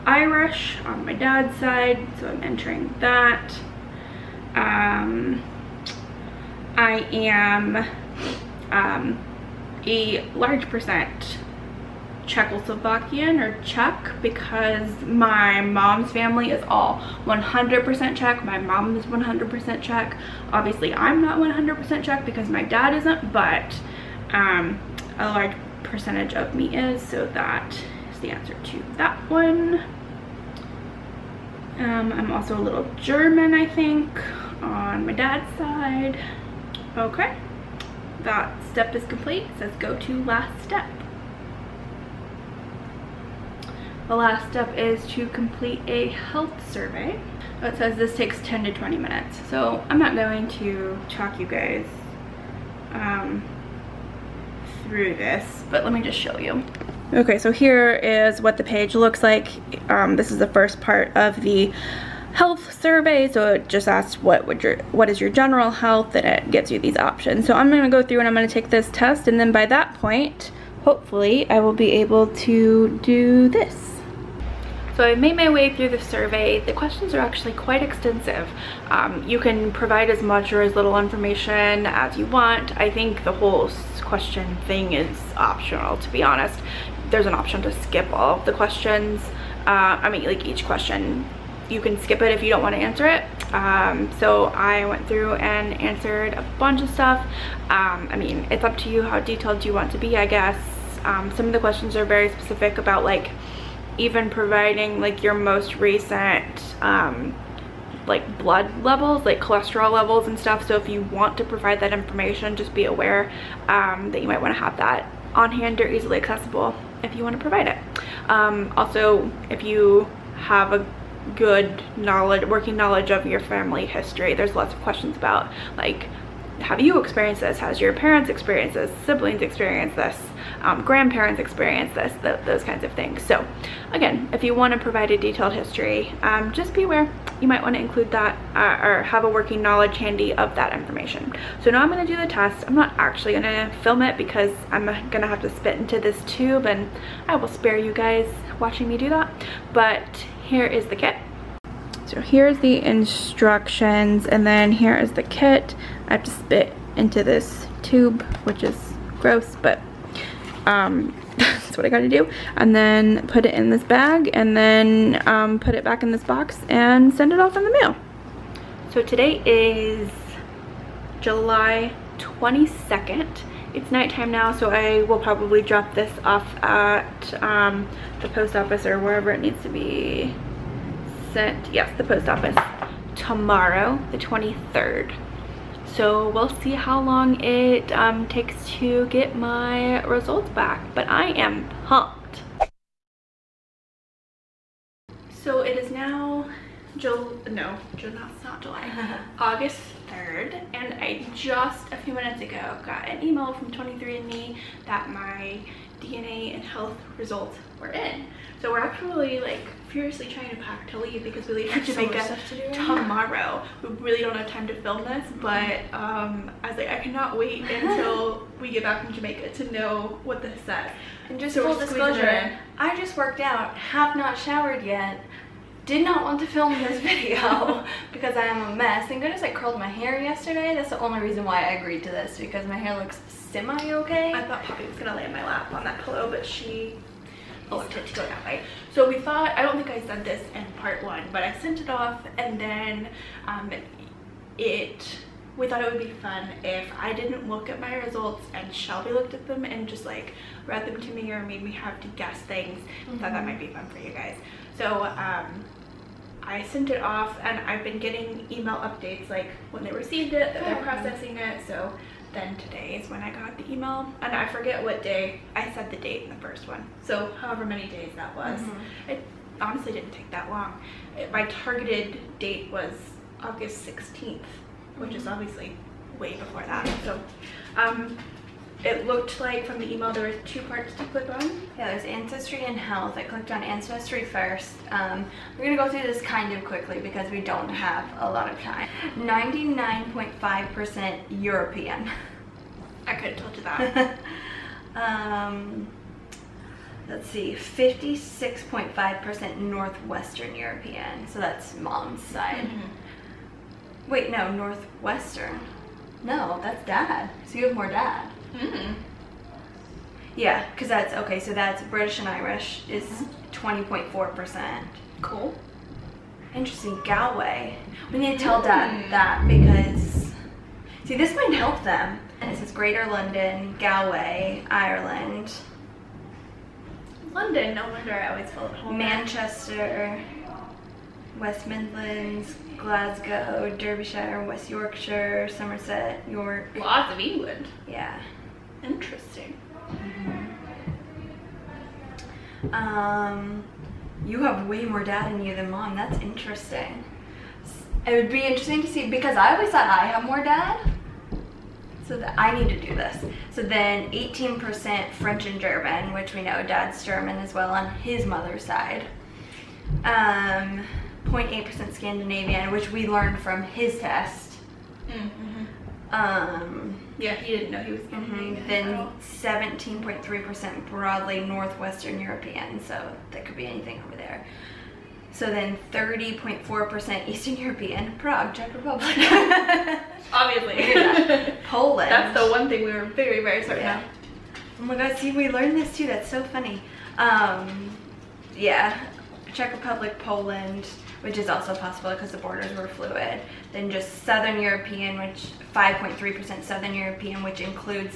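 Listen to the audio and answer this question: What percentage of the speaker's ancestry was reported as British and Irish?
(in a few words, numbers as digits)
20.4%.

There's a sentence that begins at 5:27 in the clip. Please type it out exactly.
London, no wonder I always feel at home.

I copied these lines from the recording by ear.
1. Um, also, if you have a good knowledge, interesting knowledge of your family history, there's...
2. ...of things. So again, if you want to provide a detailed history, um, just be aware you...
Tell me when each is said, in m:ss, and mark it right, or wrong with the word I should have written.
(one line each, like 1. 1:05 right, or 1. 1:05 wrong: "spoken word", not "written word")
1. 1:58 wrong: "working", not "interesting"
2. 2:12 right.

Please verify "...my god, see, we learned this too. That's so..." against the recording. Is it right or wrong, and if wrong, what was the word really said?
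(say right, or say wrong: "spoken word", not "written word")
right.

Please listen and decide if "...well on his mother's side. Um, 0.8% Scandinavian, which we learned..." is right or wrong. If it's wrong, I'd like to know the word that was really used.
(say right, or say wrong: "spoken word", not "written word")
right.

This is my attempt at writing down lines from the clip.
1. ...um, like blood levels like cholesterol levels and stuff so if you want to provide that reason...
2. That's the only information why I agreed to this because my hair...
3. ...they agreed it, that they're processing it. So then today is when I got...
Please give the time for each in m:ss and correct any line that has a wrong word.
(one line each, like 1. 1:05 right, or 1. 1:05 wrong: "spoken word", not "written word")
1. 1:46 wrong: "information", not "reason"
2. 3:50 wrong: "reason", not "information"
3. 4:19 wrong: "received", not "agreed".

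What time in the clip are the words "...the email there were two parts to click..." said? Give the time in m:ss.
4:39.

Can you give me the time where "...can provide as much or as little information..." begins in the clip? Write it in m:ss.
1:19.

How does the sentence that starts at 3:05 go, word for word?
So we'll see how long it um, takes to get my results back, but I am pumped.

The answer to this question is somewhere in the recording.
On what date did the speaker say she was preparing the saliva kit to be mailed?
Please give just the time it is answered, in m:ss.
2:51.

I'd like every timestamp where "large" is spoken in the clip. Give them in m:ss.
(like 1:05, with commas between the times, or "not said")
0:10, 0:25.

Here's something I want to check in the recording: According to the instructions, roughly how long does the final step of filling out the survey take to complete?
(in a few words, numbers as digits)
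10 to 20 minutes.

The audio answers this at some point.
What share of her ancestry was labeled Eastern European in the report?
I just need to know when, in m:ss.
6:15.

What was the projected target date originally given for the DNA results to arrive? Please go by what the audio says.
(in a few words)
August 16th.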